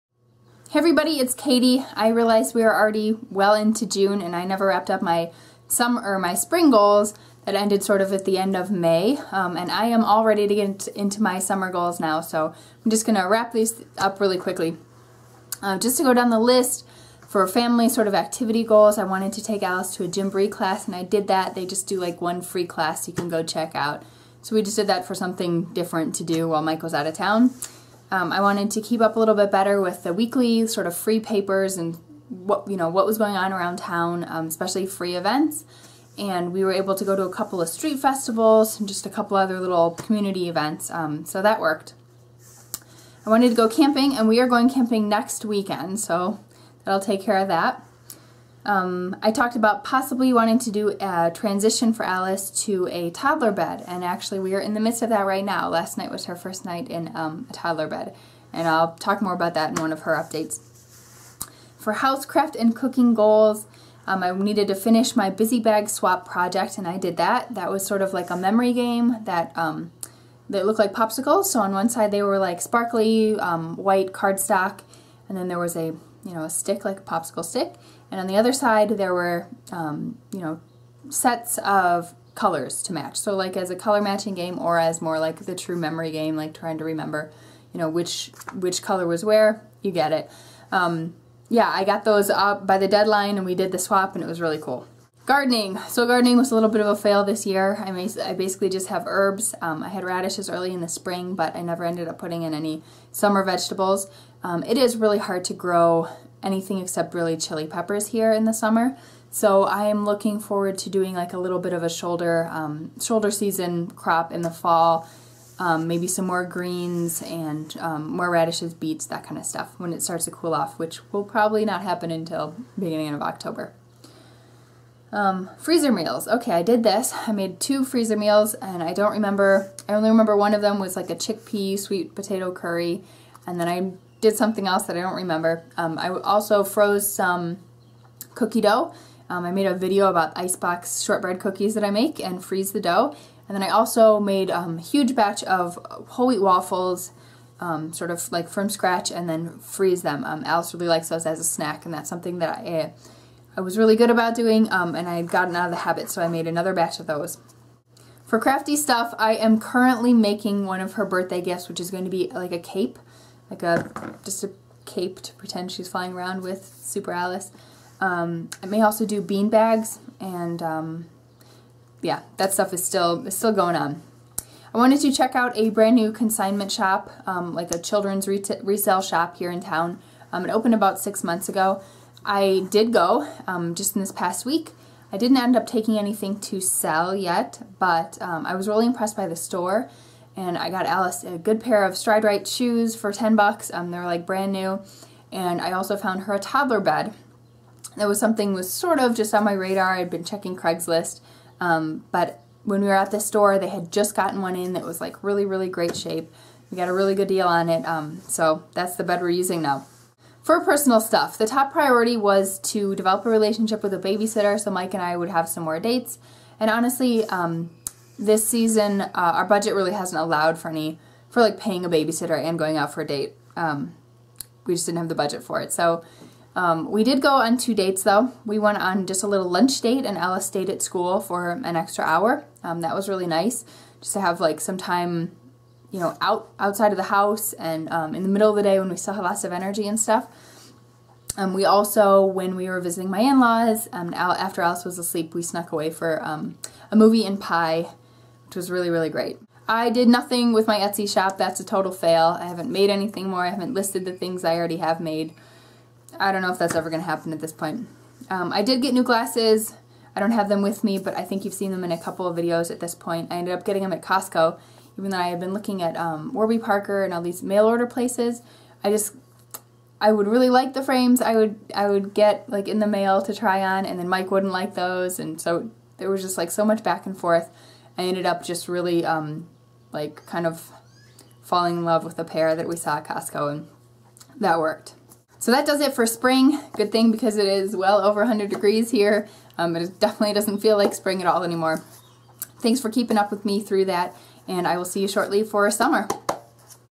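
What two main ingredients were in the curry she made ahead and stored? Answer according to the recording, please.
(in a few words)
chickpea sweet potato.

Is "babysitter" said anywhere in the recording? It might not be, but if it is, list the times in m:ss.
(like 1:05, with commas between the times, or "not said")
3:33, 3:41.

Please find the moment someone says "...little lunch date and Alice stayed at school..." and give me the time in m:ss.
3:49.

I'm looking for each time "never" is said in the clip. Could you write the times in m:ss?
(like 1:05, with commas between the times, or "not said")
0:04, 1:41.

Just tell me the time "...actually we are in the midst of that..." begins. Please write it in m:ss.
0:54.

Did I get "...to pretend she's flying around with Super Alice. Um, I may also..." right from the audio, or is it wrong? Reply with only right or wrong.
right.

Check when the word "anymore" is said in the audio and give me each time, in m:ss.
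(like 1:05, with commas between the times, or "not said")
4:51.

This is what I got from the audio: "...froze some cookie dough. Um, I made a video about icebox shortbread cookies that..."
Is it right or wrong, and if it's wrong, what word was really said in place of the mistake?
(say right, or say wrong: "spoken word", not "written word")
right.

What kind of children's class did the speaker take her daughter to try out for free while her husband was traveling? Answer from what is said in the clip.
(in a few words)
Gymboree.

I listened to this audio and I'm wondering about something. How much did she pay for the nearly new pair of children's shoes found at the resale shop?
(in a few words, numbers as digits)
$10.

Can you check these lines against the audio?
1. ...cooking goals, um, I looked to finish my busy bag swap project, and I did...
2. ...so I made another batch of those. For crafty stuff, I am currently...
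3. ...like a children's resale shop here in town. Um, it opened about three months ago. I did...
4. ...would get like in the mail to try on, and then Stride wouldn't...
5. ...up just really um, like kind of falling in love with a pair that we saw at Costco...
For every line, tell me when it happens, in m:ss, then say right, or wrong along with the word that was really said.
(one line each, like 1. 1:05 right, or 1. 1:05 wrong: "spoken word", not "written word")
1. 1:02 wrong: "needed", not "looked"
2. 2:36 right
3. 2:57 wrong: "six", not "three"
4. 4:31 wrong: "Mike", not "Stride"
5. 4:38 right.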